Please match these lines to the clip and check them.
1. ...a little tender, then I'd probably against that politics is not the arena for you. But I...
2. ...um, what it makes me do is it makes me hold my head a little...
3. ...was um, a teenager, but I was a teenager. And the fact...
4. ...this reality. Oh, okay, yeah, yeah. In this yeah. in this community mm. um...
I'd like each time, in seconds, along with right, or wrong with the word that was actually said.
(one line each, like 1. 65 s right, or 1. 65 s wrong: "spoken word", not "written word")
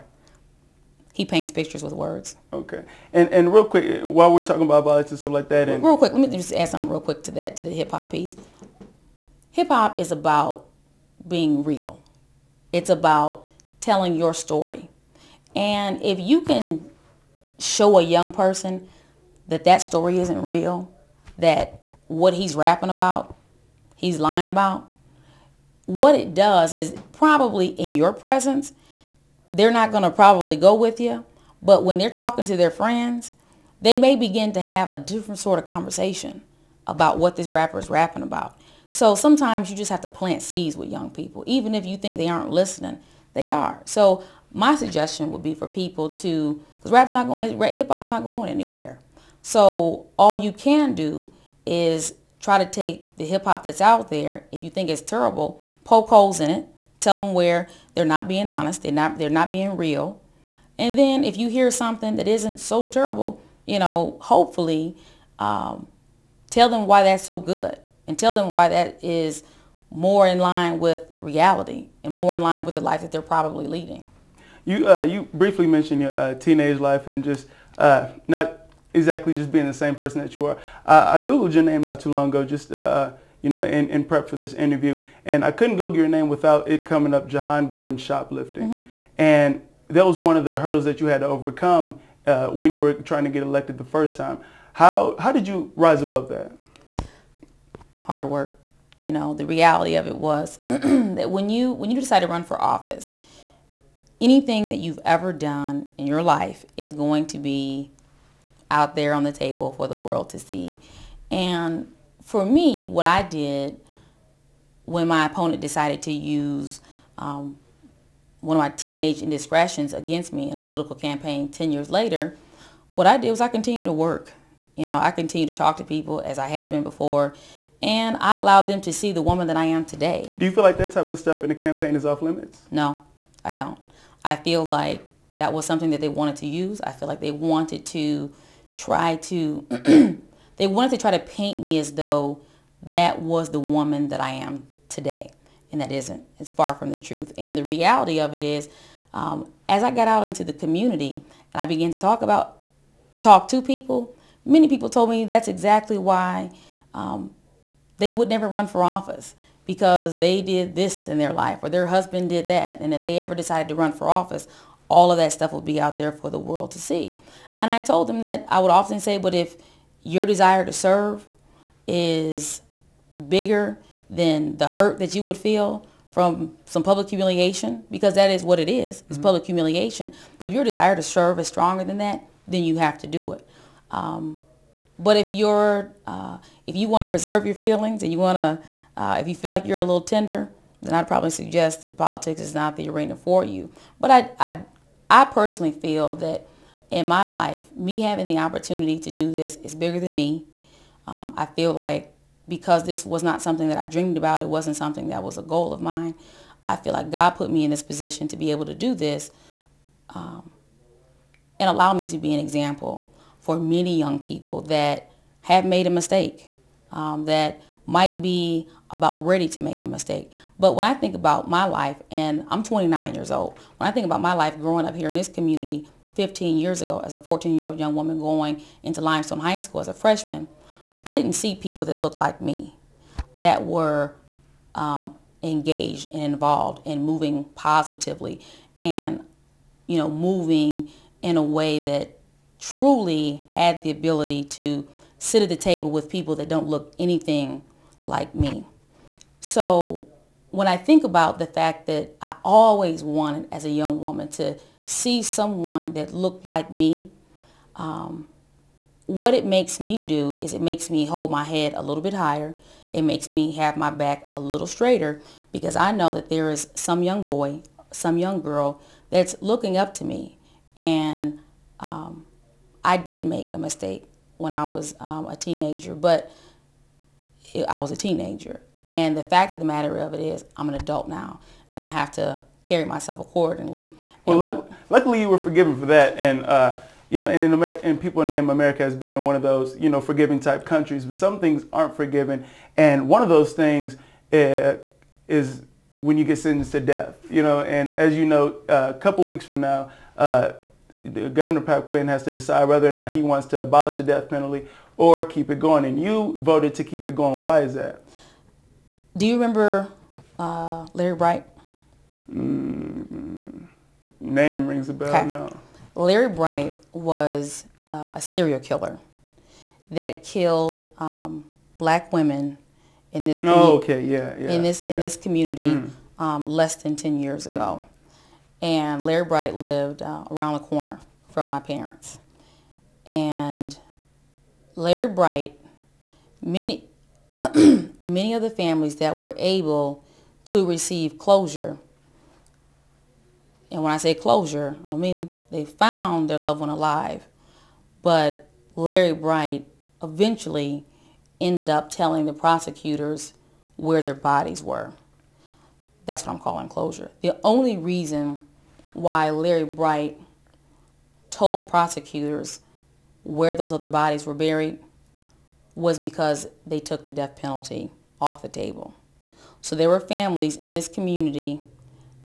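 1. 189 s wrong: "suggest", not "against"
2. 257 s right
3. 274 s right
4. 323 s wrong: "community", not "reality".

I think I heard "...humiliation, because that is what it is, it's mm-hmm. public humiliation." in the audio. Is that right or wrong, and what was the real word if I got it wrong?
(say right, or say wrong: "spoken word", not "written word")
right.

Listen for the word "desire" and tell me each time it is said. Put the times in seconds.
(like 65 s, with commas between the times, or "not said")
170 s, 180 s.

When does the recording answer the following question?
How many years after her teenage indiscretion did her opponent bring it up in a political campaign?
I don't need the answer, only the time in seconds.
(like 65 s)
121 s.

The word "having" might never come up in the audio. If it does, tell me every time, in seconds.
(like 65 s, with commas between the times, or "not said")
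198 s.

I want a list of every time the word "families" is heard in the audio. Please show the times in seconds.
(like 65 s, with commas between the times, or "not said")
338 s, 369 s.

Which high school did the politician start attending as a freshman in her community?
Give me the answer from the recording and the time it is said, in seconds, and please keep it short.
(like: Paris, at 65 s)
Limestone High School, at 229 s.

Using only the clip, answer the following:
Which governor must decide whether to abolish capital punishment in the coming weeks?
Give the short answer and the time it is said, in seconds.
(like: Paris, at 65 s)
Pat Quinn, at 301 s.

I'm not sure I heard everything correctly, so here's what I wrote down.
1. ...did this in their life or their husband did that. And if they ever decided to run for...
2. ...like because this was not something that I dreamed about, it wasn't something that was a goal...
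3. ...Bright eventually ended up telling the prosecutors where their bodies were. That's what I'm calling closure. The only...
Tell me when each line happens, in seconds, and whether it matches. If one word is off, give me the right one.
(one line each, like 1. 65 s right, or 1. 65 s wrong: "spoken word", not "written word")
1. 160 s right
2. 201 s right
3. 349 s right.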